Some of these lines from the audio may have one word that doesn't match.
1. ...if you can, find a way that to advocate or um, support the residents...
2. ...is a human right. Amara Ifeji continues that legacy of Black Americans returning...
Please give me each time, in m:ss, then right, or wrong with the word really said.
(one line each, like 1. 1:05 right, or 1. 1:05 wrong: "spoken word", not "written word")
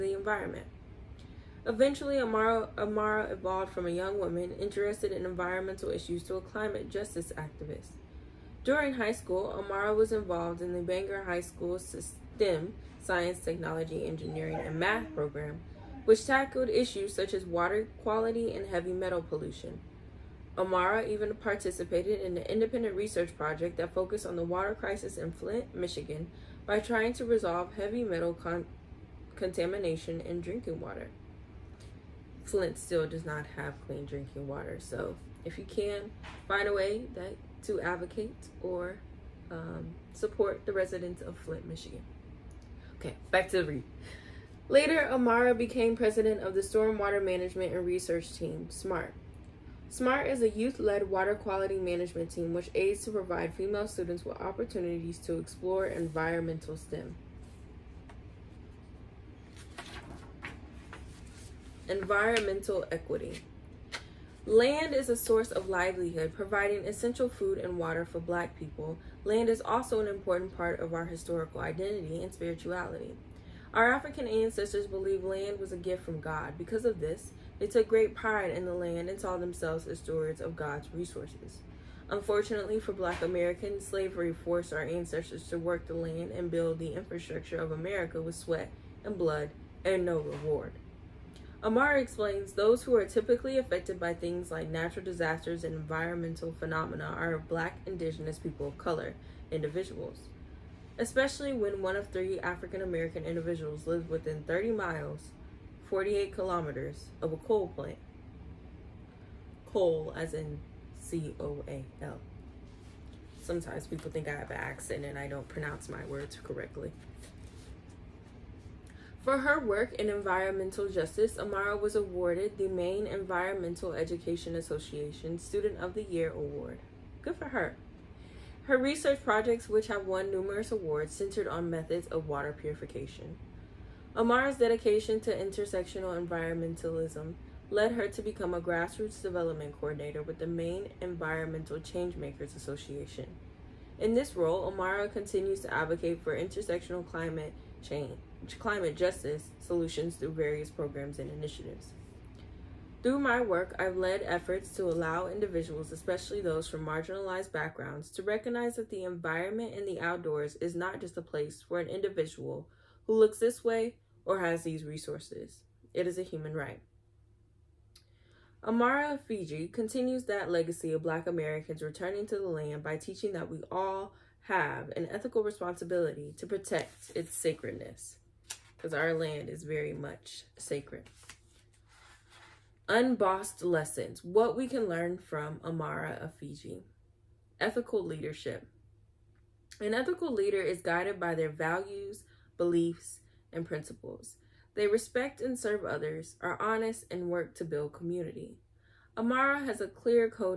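1. 0:35 right
2. 2:46 right.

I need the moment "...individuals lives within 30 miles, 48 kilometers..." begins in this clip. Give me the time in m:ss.
1:43.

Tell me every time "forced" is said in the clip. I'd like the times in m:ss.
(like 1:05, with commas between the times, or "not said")
1:24.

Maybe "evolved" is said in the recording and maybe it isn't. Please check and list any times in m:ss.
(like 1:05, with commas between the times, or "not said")
0:03.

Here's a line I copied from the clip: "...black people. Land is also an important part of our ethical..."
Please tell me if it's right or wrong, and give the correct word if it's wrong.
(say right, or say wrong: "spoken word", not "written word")
wrong: "historical", not "ethical".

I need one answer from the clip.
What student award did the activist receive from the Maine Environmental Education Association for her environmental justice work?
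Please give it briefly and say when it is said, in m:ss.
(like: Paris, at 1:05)
Student of the Year, at 2:05.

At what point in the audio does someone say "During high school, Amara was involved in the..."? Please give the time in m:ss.
0:08.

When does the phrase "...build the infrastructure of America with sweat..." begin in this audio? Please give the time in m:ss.
1:26.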